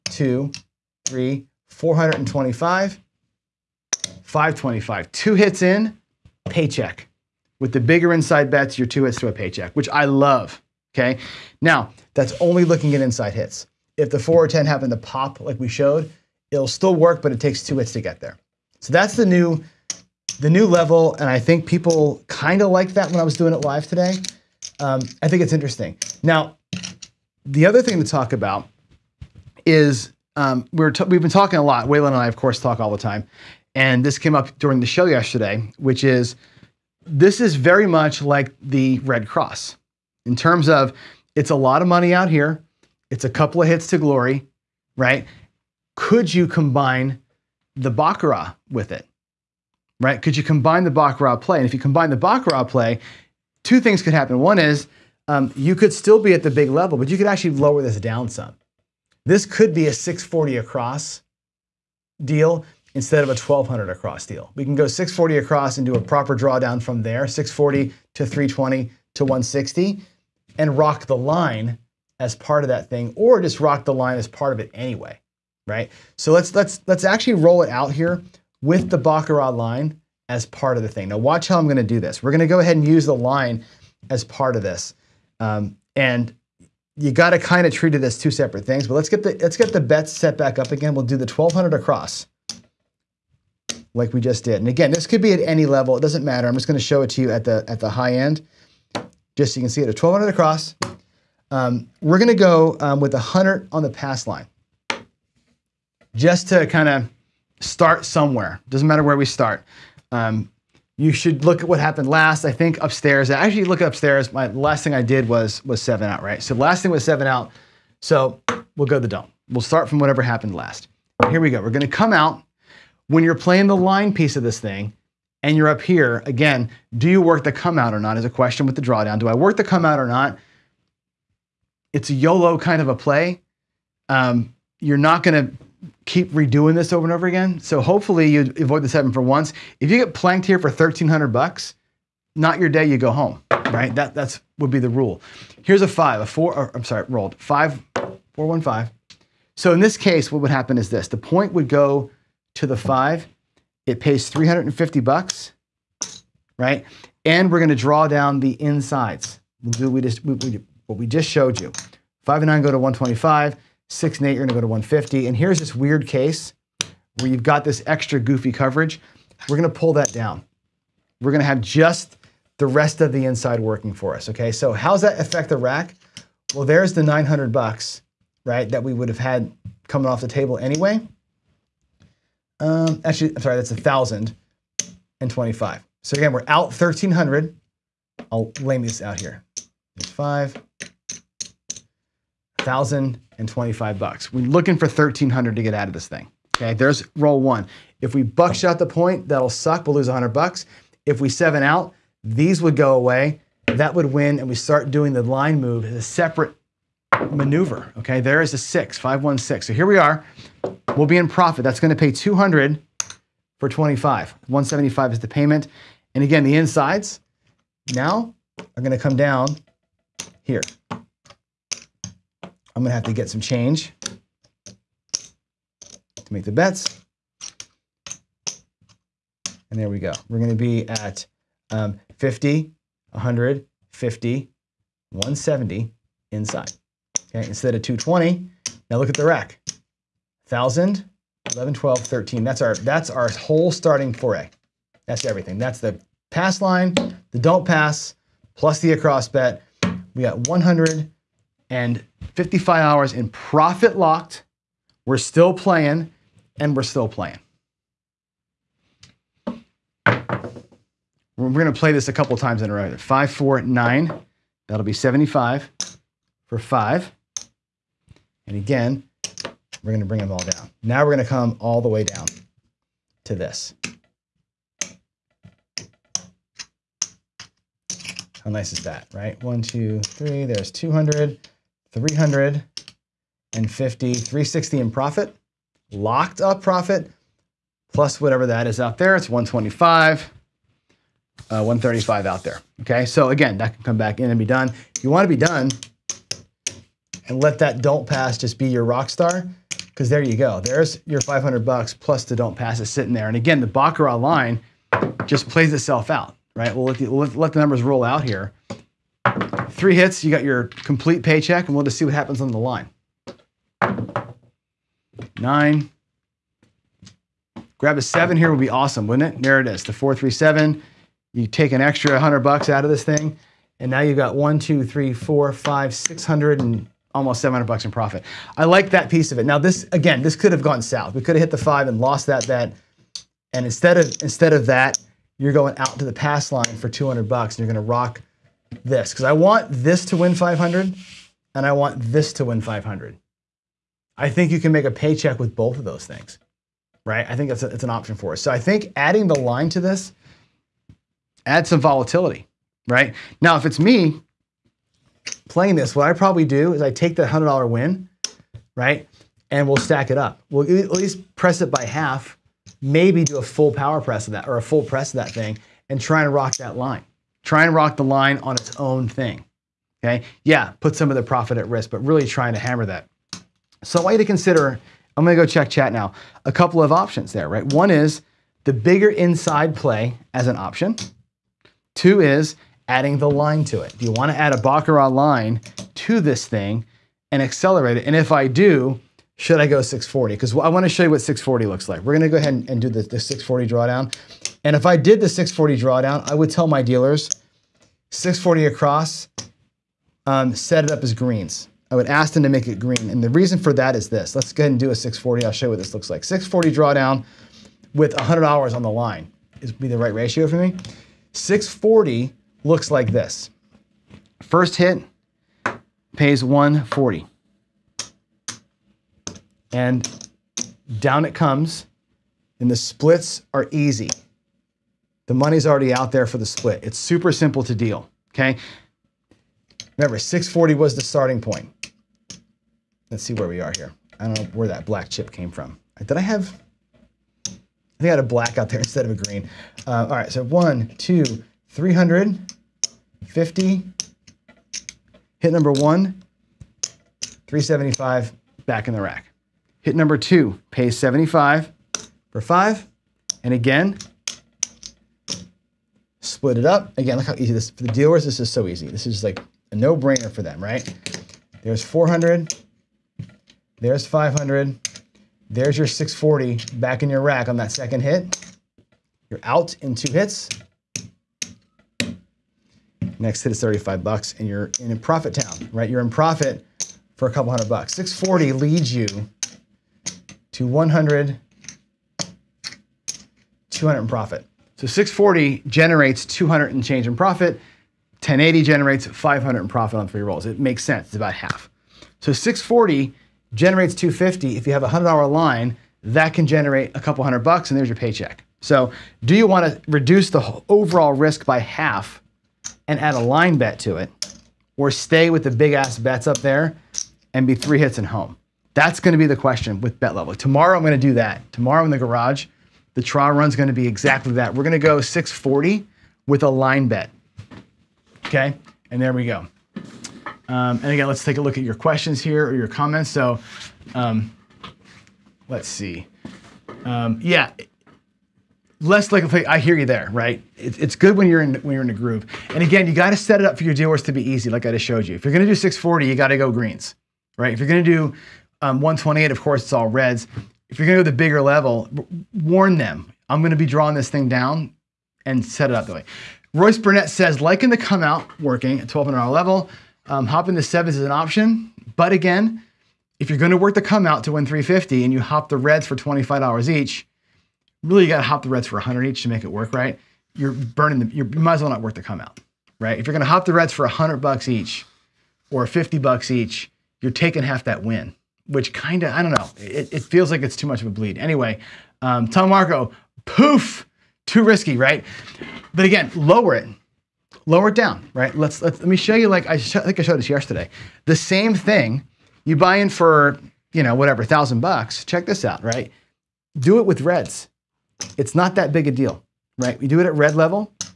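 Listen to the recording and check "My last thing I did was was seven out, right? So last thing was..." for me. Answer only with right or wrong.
right.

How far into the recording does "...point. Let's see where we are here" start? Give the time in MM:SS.
07:11.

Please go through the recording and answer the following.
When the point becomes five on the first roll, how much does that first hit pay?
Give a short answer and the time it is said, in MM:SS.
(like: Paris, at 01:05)
350, at 02:34.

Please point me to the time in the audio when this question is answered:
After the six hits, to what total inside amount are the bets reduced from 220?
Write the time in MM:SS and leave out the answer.
03:55.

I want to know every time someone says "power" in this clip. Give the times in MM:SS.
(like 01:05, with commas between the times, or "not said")
06:03.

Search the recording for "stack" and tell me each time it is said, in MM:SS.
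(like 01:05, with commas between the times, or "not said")
05:59.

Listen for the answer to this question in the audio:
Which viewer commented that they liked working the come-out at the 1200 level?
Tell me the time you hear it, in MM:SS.
09:06.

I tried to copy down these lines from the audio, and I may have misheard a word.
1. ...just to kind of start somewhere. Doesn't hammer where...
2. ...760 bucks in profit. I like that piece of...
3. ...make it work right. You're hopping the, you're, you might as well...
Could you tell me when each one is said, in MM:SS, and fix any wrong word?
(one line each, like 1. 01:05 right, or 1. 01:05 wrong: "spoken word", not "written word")
1. 01:46 wrong: "matter", not "hammer"
2. 05:27 wrong: "700", not "760"
3. 09:19 wrong: "burning", not "hopping".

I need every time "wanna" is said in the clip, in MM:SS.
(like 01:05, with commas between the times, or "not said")
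06:24, 06:30.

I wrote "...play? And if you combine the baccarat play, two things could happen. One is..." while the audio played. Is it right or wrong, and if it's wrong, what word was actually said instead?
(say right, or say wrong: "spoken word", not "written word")
right.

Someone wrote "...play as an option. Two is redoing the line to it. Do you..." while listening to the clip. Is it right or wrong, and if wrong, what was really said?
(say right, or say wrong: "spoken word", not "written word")
wrong: "adding", not "redoing".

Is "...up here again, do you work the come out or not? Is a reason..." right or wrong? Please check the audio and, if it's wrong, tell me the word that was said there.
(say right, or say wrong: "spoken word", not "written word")
wrong: "question", not "reason".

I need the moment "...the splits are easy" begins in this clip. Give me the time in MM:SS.
07:02.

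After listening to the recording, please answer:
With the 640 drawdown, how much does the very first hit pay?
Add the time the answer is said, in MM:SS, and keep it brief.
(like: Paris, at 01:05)
140, at 06:56.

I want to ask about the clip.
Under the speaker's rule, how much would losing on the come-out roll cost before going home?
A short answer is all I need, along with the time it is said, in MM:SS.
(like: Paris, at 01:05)
1300, at 02:20.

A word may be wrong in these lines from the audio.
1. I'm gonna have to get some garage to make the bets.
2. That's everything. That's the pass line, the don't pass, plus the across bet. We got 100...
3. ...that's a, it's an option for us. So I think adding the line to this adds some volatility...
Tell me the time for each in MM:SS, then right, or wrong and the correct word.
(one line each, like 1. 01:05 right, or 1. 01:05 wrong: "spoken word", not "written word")
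1. 03:42 wrong: "change", not "garage"
2. 04:05 right
3. 05:47 right.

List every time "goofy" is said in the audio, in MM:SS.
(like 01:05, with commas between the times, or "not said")
02:48.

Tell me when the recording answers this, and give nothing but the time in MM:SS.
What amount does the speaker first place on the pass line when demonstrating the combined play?
01:43.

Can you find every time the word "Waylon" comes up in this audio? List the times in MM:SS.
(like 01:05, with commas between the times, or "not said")
00:31.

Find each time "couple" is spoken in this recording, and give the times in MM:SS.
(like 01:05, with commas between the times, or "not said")
00:43, 04:22, 06:16, 07:57, 08:16.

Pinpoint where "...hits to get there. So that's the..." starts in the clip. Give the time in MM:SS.
00:17.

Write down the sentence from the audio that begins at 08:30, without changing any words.
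Tomorrow I'm going to do that.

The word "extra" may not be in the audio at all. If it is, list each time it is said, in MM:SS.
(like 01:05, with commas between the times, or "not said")
02:47, 05:21.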